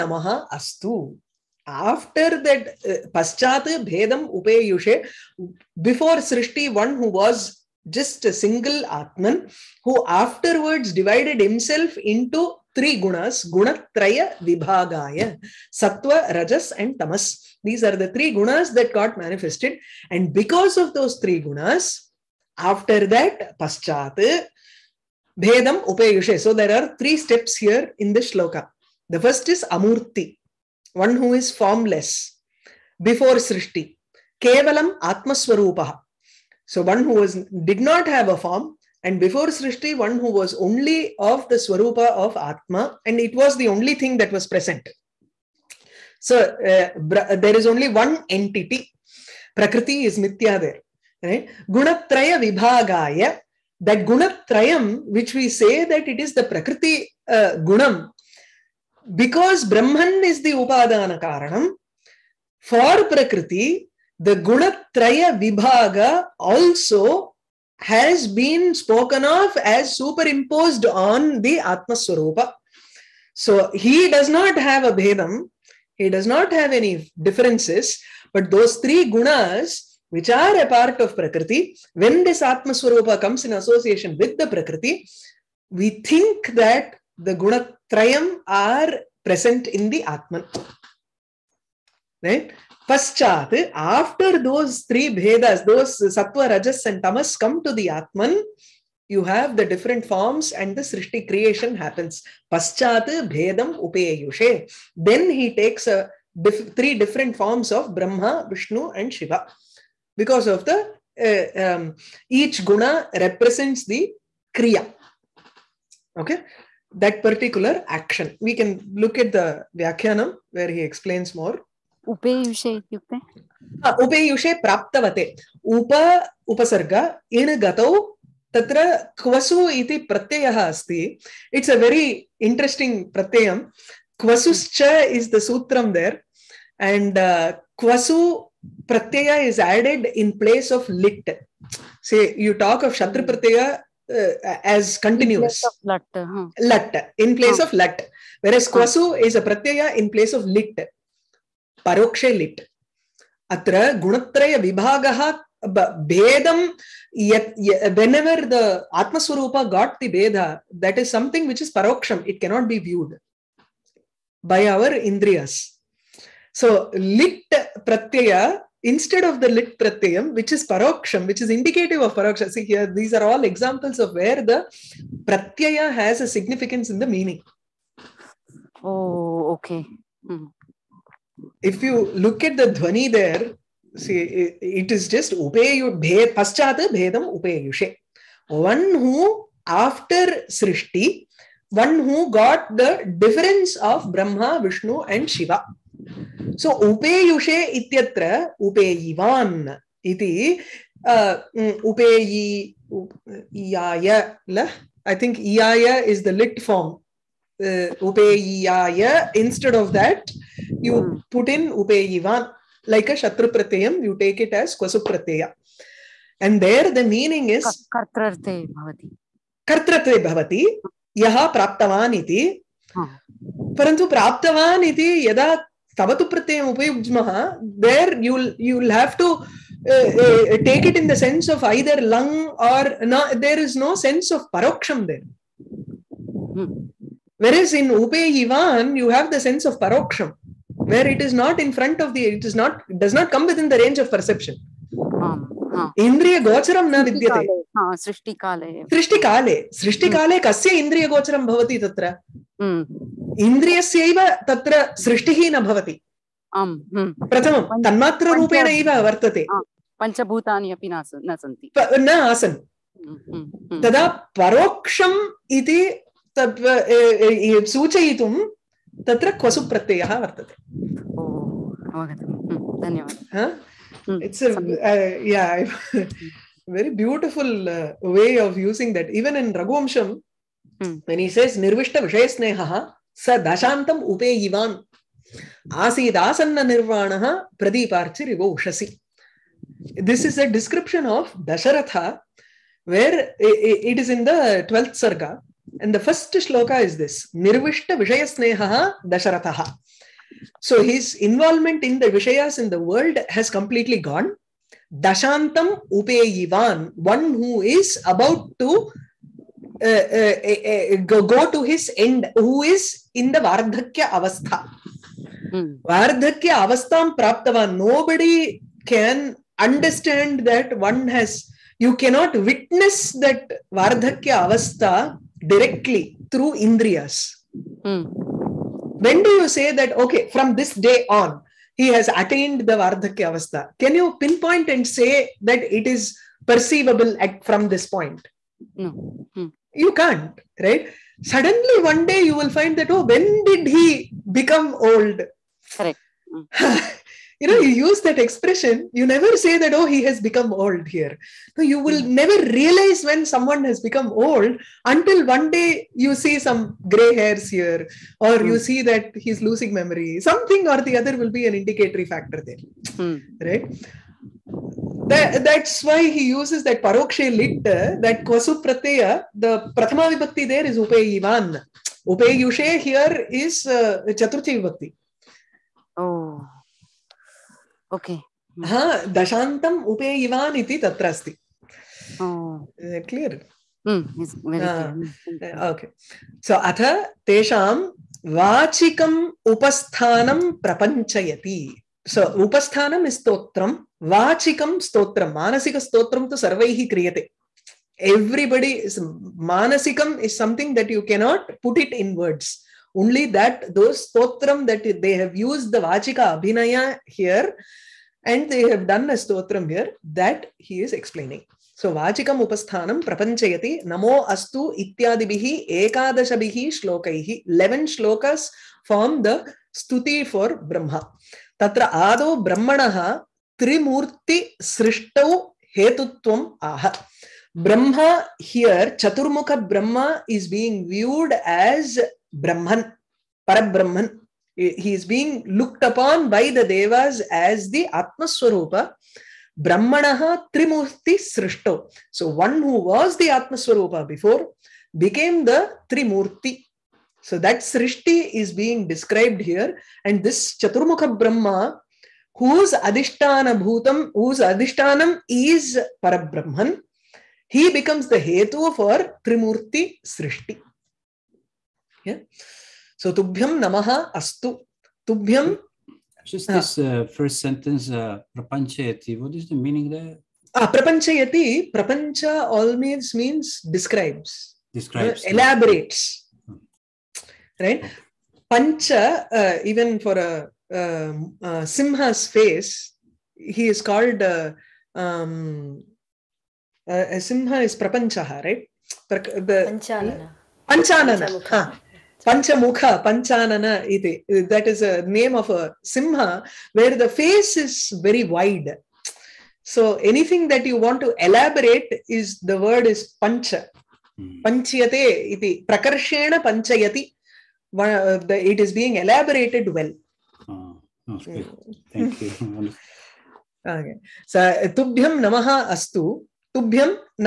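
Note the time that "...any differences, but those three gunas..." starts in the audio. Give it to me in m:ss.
1:16.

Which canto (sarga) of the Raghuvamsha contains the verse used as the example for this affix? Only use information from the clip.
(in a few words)
12th.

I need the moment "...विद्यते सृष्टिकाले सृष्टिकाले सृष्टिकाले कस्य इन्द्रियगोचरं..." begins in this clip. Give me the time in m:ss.
4:07.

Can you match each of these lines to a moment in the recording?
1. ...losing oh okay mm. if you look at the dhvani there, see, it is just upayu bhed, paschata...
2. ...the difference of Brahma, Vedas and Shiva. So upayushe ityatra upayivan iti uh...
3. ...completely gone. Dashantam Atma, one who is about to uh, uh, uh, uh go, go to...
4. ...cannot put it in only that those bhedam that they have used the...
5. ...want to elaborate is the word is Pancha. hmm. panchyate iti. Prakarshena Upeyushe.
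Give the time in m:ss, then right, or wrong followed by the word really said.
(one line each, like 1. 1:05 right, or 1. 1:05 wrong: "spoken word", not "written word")
1. 2:57 wrong: "meaning", not "losing"
2. 3:12 wrong: "Vishnu", not "Vedas"
3. 5:03 wrong: "Upeyivan", not "Atma"
4. 6:41 wrong: "stotram", not "bhedam"
5. 8:20 wrong: "Panchayati", not "Upeyushe".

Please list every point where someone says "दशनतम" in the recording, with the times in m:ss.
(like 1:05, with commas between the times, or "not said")
4:43, 6:19.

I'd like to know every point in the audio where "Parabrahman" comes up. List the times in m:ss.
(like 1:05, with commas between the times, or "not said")
7:13, 7:36.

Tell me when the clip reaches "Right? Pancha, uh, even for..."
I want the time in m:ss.
7:57.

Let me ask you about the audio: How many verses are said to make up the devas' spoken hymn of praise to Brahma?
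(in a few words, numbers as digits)
11.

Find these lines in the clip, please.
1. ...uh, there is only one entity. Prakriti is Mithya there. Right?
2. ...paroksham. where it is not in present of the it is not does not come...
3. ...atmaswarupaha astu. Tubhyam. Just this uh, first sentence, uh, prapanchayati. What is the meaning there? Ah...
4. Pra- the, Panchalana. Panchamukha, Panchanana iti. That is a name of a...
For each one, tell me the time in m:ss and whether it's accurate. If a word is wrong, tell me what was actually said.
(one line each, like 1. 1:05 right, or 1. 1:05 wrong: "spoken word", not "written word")
1. 0:46 right
2. 3:59 wrong: "front", not "present"
3. 7:43 wrong: "namaha", not "atmaswarupaha"
4. 8:09 right.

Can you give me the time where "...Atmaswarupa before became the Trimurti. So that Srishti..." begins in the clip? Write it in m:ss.
7:23.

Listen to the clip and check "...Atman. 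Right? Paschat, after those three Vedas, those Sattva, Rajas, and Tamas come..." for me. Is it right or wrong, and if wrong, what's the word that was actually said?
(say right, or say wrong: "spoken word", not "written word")
right.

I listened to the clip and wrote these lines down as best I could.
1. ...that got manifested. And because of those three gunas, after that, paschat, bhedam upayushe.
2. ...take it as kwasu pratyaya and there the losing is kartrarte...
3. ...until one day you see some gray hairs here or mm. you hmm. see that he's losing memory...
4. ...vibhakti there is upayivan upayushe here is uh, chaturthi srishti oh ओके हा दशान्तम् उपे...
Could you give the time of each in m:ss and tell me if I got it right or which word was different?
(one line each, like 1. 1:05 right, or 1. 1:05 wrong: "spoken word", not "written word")
1. 0:18 right
2. 3:34 wrong: "meaning", not "losing"
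3. 5:54 right
4. 6:10 wrong: "vibhakti", not "srishti".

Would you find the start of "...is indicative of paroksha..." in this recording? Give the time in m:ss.
2:51.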